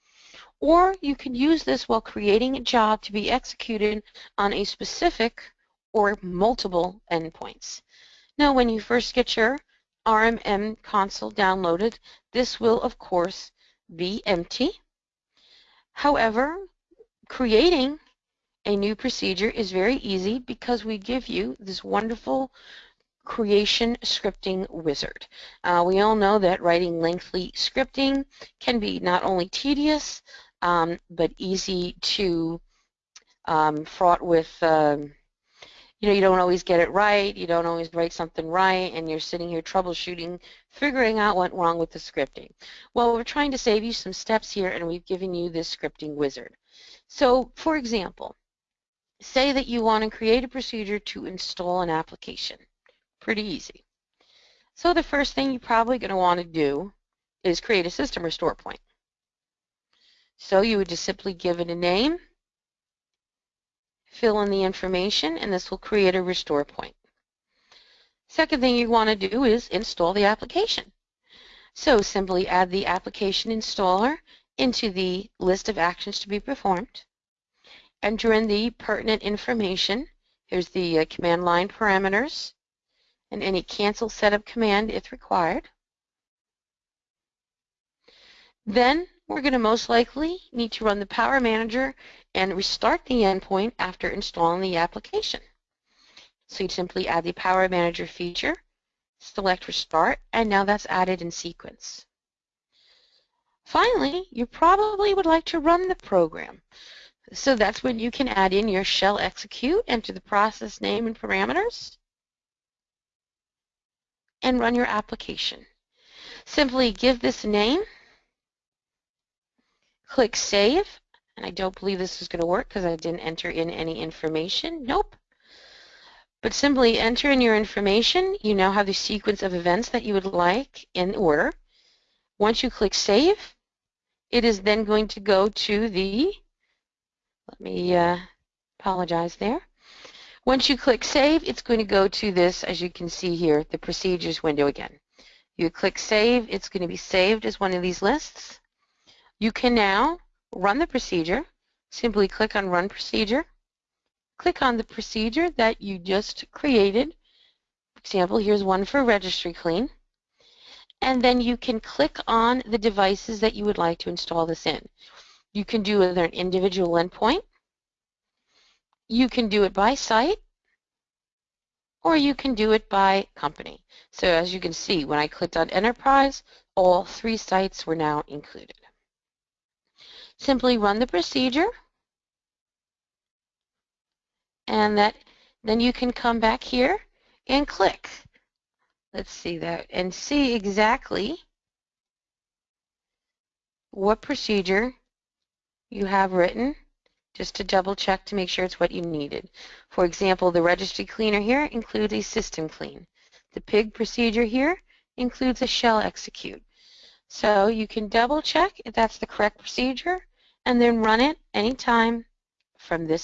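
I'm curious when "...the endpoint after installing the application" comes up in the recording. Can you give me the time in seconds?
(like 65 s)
93 s.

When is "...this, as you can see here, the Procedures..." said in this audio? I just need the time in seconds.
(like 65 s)
142 s.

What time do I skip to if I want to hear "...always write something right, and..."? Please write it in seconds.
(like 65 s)
37 s.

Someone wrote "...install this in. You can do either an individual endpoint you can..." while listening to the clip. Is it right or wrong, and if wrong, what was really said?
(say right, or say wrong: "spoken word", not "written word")
right.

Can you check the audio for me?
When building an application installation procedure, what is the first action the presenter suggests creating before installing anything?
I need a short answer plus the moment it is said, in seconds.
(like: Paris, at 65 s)
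System restore point, at 57 s.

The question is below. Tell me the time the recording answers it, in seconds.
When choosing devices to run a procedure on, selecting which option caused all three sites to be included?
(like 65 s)
175 s.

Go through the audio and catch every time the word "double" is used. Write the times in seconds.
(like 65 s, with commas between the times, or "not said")
197 s, 208 s.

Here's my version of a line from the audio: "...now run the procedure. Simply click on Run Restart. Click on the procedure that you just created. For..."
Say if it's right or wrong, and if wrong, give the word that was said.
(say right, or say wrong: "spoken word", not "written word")
wrong: "Procedure", not "Restart".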